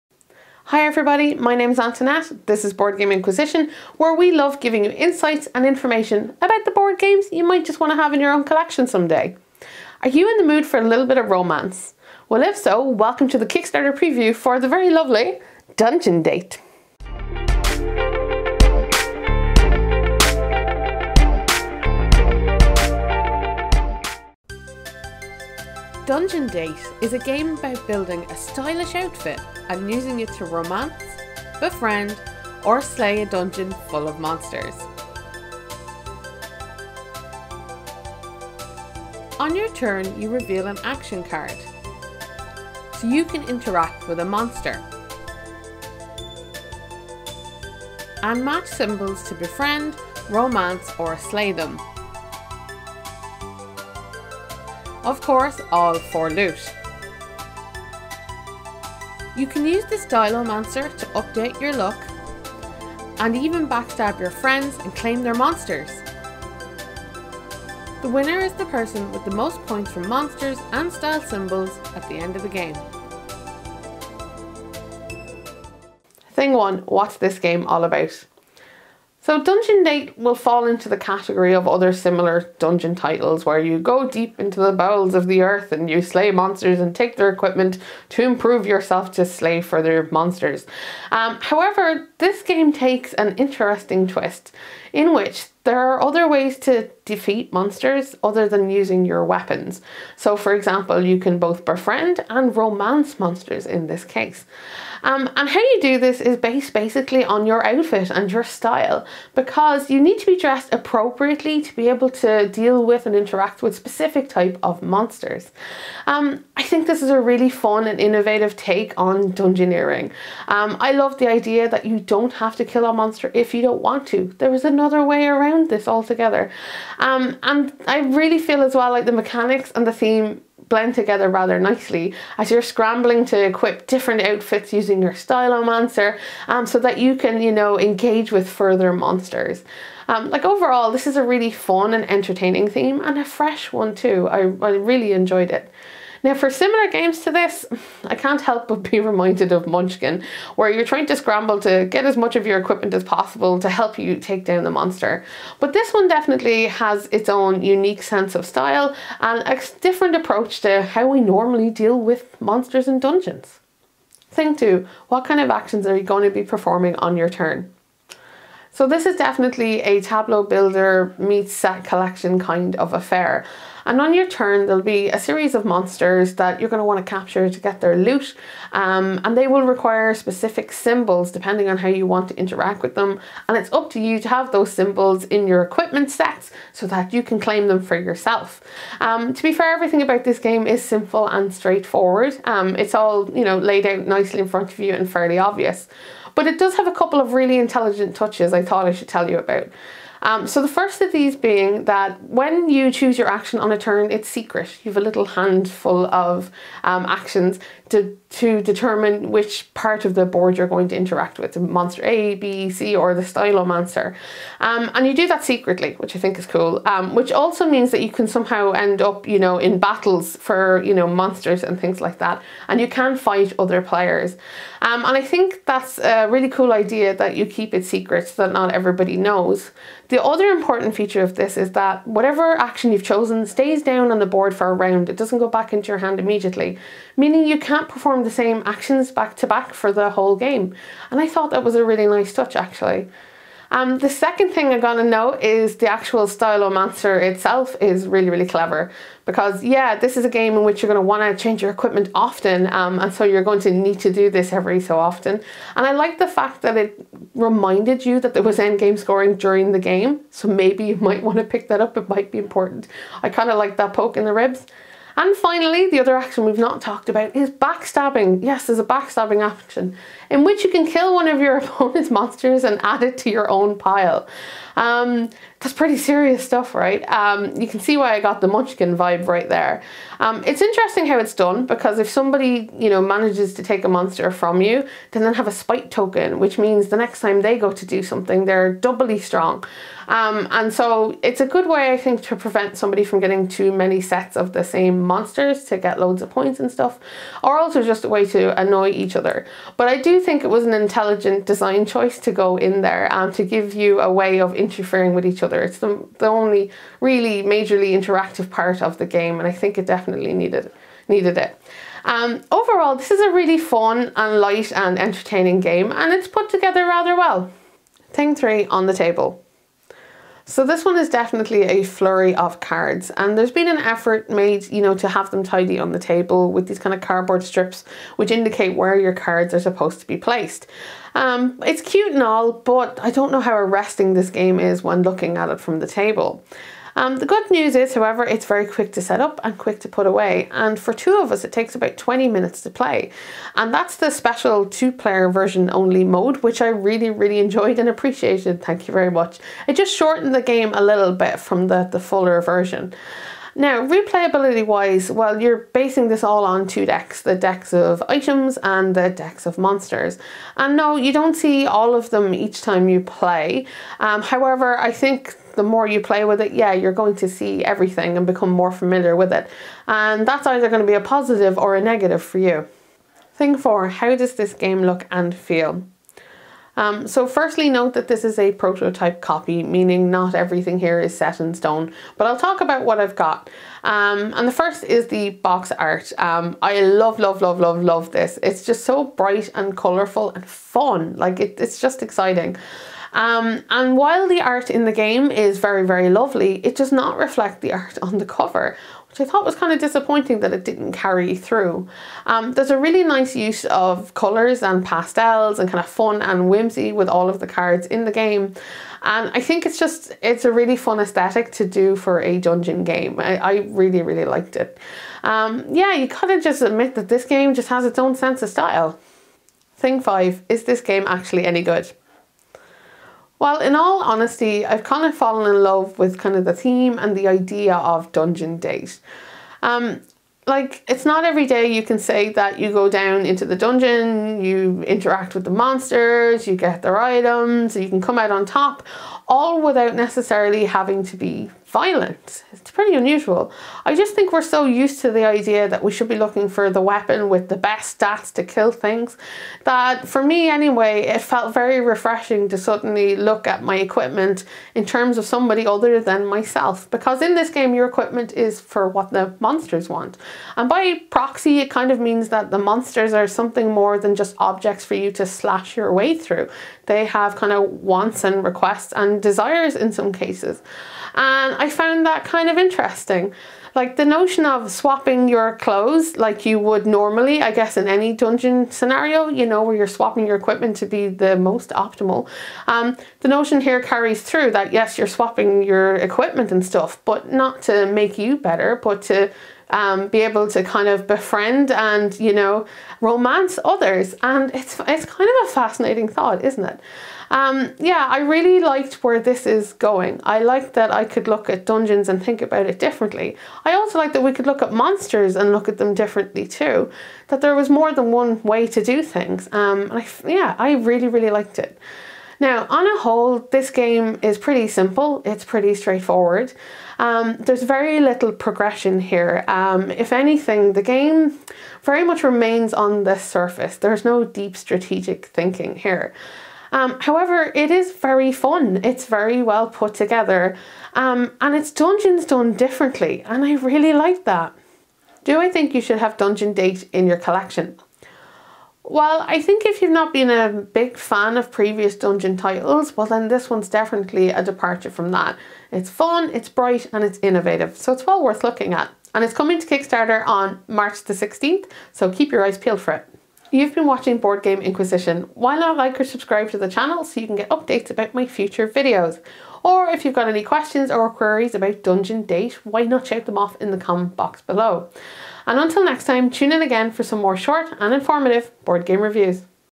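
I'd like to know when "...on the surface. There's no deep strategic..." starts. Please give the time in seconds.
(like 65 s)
522 s.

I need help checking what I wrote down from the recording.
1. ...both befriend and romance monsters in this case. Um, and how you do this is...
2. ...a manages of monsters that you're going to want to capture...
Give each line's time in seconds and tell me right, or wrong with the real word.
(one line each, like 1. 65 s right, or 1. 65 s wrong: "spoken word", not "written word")
1. 101 s right
2. 175 s wrong: "series", not "manages".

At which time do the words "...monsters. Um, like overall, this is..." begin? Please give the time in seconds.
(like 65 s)
138 s.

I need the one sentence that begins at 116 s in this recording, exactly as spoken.
Um, I think this is a really fun and innovative take on dungeoneering.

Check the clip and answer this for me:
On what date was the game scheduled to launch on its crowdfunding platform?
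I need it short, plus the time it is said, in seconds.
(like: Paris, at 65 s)
March 16, at 550 s.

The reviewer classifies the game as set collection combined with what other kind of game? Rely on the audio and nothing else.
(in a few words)
Tableau builder.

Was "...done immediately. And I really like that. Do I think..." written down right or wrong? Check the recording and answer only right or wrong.
wrong.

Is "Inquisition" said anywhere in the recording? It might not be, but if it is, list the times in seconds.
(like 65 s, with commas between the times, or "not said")
3 s, 554 s.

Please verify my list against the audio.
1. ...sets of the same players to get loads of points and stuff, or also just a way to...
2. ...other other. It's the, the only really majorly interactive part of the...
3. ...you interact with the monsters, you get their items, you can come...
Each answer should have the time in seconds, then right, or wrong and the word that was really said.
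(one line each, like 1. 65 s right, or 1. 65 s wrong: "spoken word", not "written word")
1. 294 s wrong: "monsters", not "players"
2. 305 s right
3. 434 s right.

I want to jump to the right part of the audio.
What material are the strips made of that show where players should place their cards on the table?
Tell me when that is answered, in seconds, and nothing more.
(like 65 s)
327 s.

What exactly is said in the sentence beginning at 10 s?
Are you in the mood for a little bit of romance?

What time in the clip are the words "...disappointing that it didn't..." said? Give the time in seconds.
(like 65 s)
399 s.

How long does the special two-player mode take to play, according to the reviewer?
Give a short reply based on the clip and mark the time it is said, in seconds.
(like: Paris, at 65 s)
About 20 minutes, at 341 s.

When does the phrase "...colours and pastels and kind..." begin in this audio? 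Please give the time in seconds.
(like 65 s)
404 s.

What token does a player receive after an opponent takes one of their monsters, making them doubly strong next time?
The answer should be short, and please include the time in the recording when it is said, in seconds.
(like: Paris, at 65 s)
Spite token, at 285 s.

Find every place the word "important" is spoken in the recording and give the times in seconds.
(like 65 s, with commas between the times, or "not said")
230 s, 262 s.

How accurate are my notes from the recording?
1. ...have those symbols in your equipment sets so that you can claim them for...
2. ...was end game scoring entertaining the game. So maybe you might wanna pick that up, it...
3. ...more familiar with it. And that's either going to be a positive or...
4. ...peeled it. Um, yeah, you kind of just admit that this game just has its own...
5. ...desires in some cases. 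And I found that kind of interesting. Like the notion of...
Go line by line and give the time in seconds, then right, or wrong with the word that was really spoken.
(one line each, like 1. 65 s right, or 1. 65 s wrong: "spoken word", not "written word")
1. 184 s right
2. 258 s wrong: "during", not "entertaining"
3. 368 s right
4. 414 s wrong: "liked", not "peeled"
5. 469 s right.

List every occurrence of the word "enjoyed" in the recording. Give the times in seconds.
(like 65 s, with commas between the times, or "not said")
145 s, 347 s.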